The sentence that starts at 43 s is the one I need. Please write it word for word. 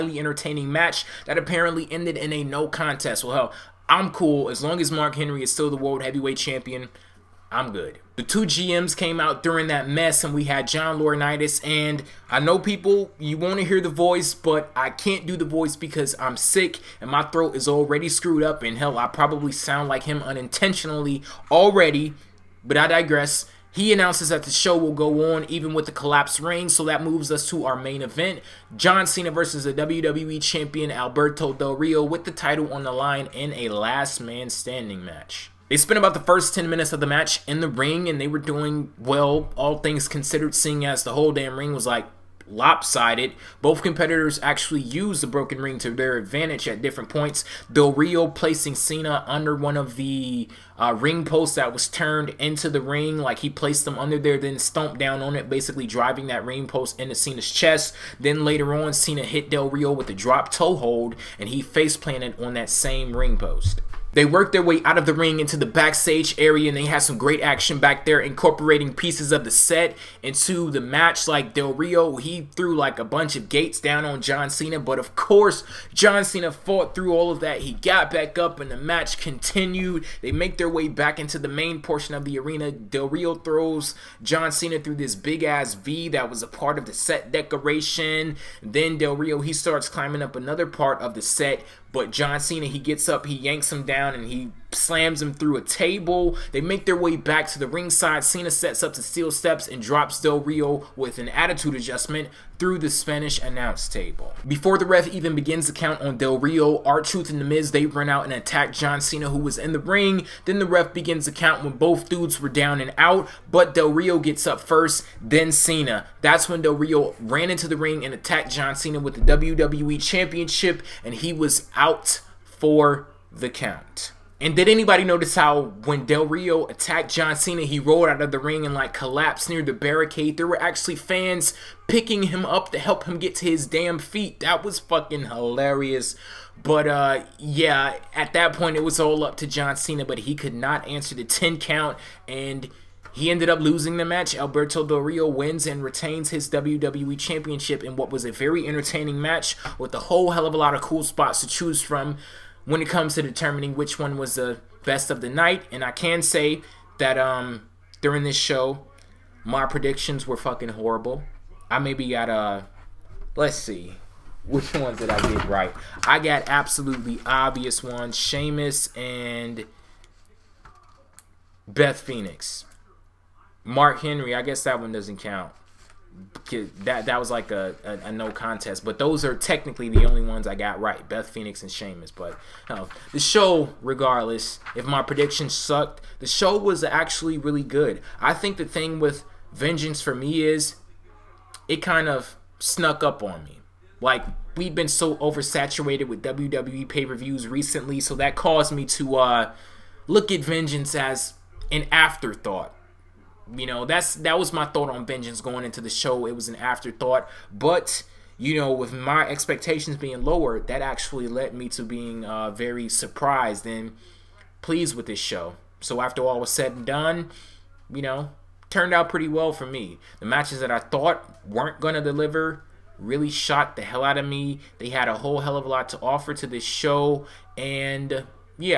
Both competitors actually used the broken ring to their advantage at different points.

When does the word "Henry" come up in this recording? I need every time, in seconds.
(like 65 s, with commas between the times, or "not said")
5 s, 174 s.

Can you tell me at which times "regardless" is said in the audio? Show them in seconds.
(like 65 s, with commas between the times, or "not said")
183 s.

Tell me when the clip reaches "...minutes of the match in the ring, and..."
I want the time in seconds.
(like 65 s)
36 s.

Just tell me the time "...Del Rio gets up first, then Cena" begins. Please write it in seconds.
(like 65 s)
113 s.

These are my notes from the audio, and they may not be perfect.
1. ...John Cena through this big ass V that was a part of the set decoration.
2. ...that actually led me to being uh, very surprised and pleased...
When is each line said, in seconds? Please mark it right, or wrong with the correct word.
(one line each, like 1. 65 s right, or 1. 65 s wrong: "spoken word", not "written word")
1. 84 s right
2. 210 s right.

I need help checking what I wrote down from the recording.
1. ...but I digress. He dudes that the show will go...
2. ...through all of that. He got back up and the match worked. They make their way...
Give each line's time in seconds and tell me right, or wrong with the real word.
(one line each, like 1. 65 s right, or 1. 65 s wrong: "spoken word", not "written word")
1. 22 s wrong: "announces", not "dudes"
2. 76 s wrong: "continued", not "worked".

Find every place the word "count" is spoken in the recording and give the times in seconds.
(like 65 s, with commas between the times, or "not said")
105 s, 111 s, 123 s, 141 s, 175 s.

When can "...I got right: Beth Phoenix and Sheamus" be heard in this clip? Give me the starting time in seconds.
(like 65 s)
180 s.